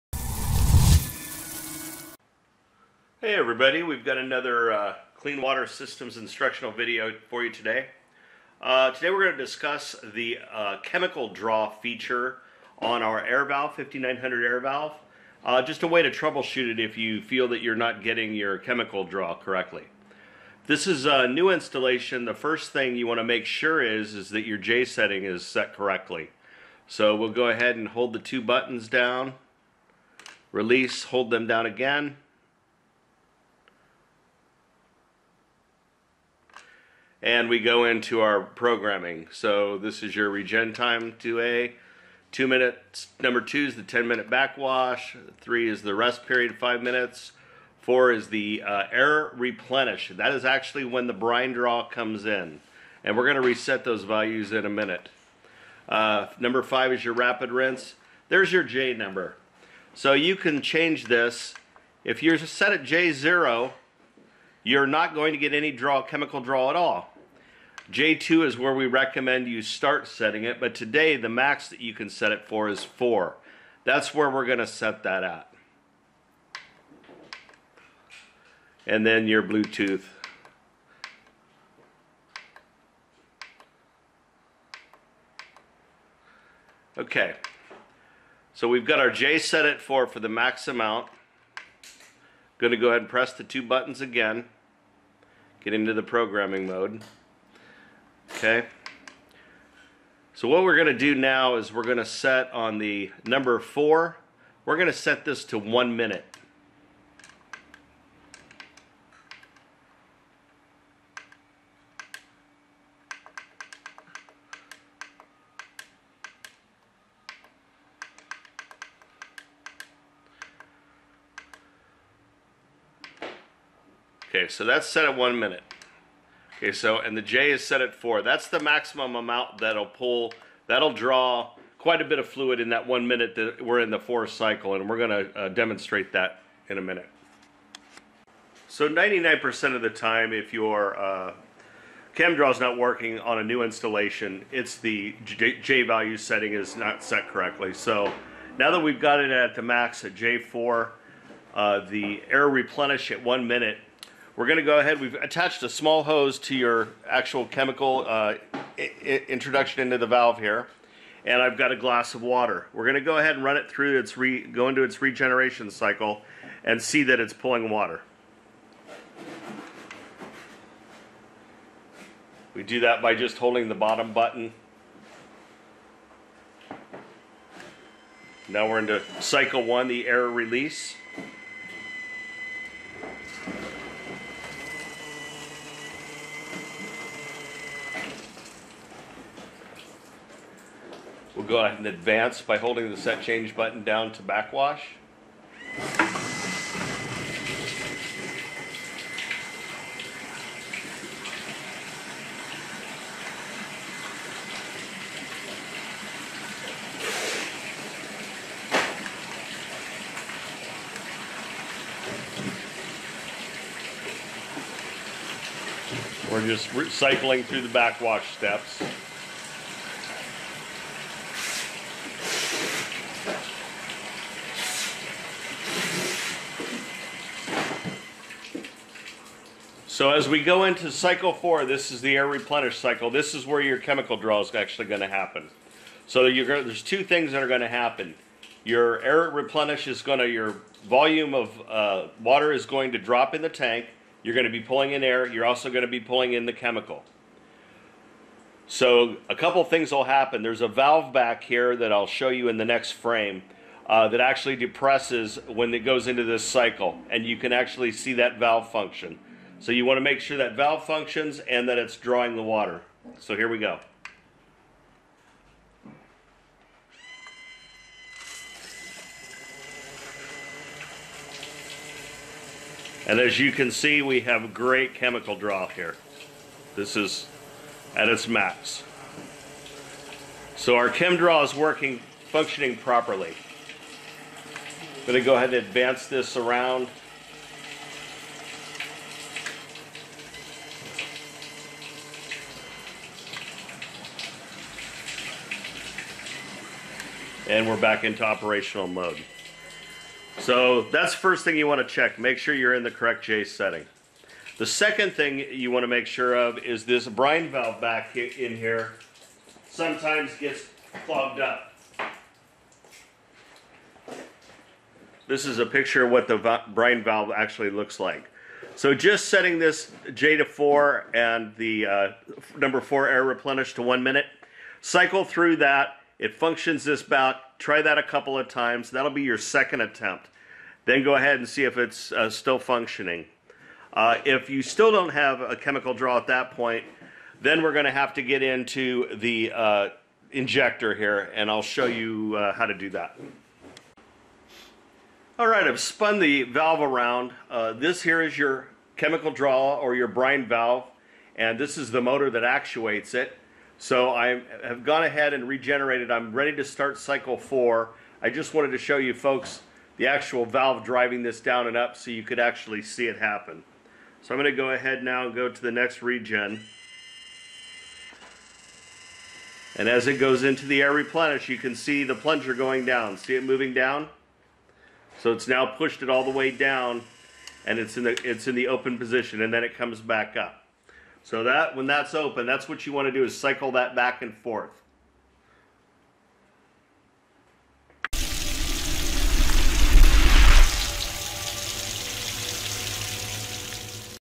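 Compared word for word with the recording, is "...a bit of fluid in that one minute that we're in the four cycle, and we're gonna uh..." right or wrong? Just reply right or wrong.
right.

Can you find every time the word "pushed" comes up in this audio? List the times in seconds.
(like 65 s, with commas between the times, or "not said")
375 s.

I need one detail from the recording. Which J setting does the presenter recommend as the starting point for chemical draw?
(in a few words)
J2.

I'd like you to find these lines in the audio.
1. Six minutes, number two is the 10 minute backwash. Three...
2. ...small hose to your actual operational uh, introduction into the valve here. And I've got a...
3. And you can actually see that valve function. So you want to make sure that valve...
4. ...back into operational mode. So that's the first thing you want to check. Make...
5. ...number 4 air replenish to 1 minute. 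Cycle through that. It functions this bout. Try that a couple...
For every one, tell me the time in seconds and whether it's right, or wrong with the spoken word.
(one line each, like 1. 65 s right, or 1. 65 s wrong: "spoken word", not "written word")
1. 42 s wrong: "Two", not "Six"
2. 155 s wrong: "chemical", not "operational"
3. 257 s right
4. 297 s right
5. 322 s right.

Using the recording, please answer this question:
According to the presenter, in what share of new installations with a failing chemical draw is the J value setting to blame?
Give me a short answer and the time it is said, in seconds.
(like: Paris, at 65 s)
99%, at 138 s.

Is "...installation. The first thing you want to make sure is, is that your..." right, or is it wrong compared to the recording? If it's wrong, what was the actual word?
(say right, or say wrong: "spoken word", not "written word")
right.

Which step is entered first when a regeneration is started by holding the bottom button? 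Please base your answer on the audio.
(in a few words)
air release.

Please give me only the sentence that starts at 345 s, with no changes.
All right, I've spun the valve around.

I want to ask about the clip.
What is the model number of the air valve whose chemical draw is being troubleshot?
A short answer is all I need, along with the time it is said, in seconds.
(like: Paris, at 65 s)
5900, at 13 s.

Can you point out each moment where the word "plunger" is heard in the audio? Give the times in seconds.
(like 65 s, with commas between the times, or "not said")
372 s.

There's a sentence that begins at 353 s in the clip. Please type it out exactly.
So I have gone ahead and regenerated.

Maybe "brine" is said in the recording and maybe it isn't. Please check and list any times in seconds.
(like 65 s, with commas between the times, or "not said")
51 s, 307 s, 316 s, 350 s.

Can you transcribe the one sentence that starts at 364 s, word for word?
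So I'm going to go ahead now and go to the next regen.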